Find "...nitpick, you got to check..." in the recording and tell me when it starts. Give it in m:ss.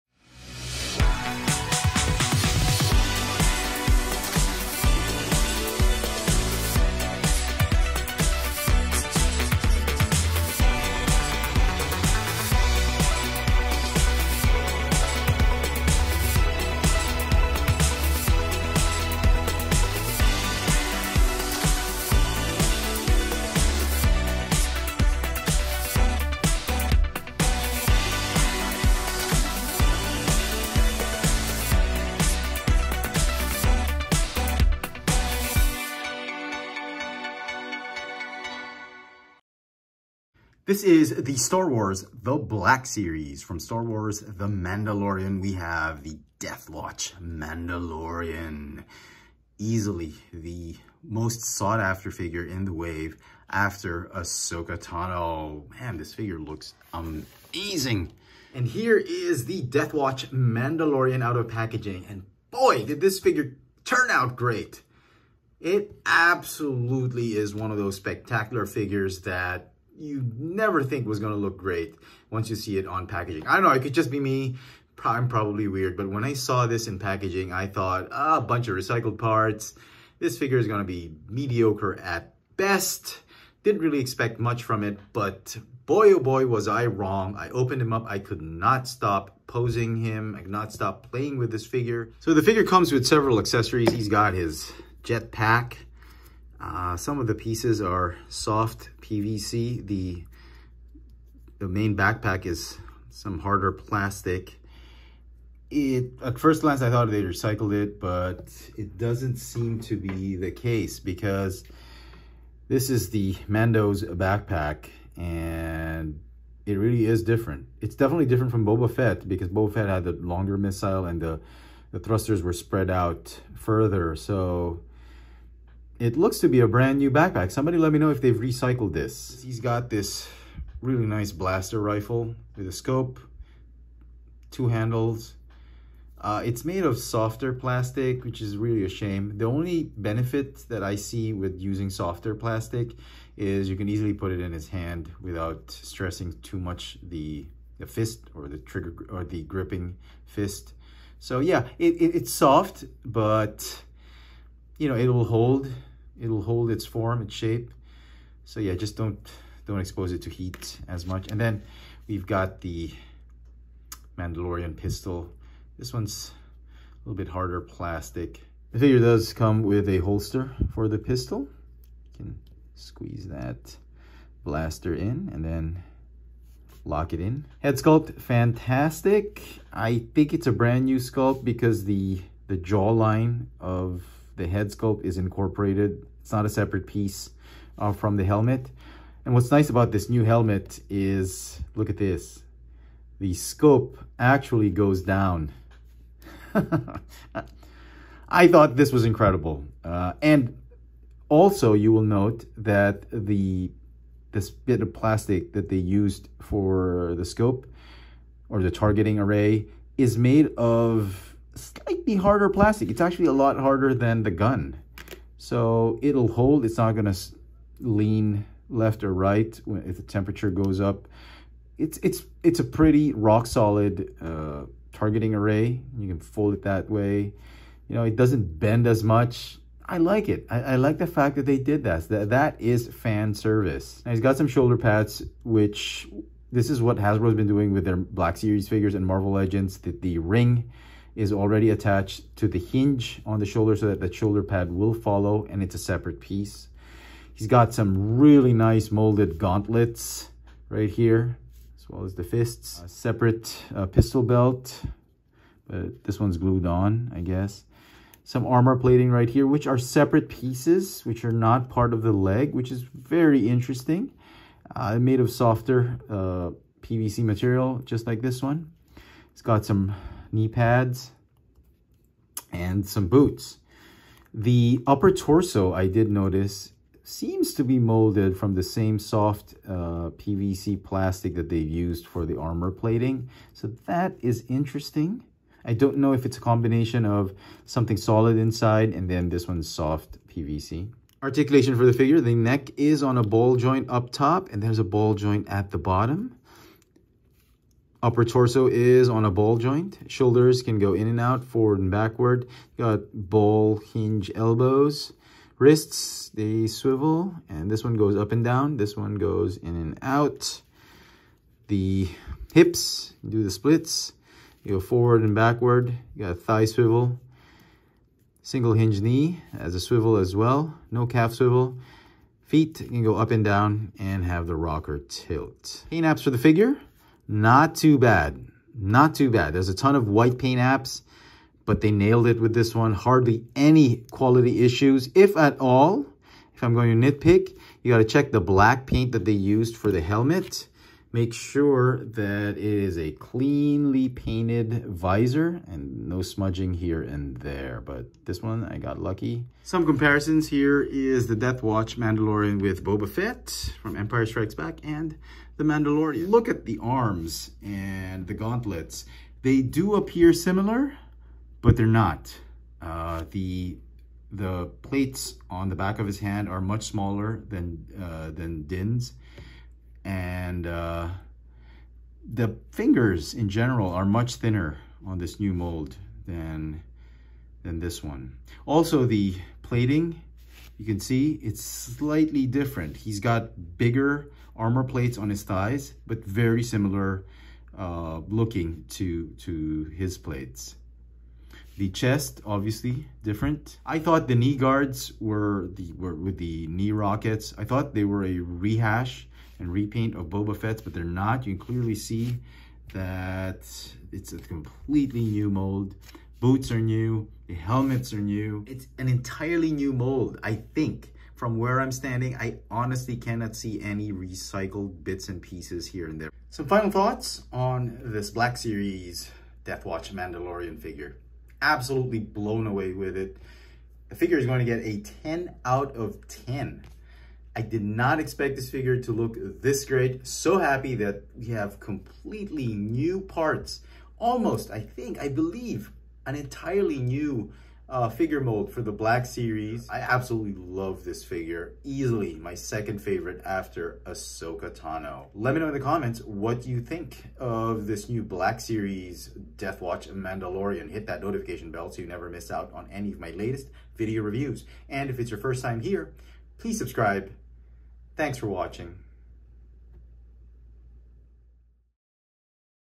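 5:37.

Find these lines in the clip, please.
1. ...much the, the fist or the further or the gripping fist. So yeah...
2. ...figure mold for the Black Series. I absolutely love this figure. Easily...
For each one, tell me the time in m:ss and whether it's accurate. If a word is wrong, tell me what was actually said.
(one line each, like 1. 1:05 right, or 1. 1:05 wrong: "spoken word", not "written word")
1. 2:26 wrong: "trigger", not "further"
2. 7:18 right.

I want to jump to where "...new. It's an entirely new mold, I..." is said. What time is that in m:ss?
6:48.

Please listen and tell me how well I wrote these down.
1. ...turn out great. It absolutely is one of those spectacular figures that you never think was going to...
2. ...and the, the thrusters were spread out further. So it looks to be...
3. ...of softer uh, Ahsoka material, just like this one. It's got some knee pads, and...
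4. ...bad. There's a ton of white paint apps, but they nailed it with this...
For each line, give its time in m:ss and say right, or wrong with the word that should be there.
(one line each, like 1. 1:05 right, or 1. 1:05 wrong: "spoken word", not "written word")
1. 1:03 right
2. 2:01 right
3. 4:25 wrong: "PVC", not "Ahsoka"
4. 5:29 right.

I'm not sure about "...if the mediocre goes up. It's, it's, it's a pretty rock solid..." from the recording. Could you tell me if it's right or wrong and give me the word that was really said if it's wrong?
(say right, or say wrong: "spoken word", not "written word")
wrong: "temperature", not "mediocre".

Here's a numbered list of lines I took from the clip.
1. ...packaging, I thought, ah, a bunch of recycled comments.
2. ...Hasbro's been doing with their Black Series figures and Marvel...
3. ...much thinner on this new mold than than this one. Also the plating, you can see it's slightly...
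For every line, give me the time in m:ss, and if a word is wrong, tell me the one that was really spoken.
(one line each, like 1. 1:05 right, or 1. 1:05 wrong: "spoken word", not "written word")
1. 1:16 wrong: "parts", not "comments"
2. 3:56 right
3. 6:14 right.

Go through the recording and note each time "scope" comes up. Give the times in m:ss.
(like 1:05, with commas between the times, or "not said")
2:12, 3:13, 3:27.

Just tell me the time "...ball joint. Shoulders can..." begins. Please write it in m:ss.
4:59.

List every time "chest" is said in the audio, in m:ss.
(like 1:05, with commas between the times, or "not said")
6:31.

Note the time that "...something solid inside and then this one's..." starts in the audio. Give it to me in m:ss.
4:47.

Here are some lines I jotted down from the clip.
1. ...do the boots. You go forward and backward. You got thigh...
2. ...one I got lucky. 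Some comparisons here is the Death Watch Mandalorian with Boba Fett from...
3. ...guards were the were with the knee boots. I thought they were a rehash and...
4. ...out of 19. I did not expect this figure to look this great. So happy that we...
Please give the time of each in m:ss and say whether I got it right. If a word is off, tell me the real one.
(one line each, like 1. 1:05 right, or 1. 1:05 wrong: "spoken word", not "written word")
1. 5:13 wrong: "splits", not "boots"
2. 5:48 right
3. 6:34 wrong: "rockets", not "boots"
4. 7:05 wrong: "10", not "19".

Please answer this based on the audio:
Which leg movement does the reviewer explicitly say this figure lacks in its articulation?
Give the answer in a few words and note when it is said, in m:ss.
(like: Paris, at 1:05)
Calf swivel, at 5:21.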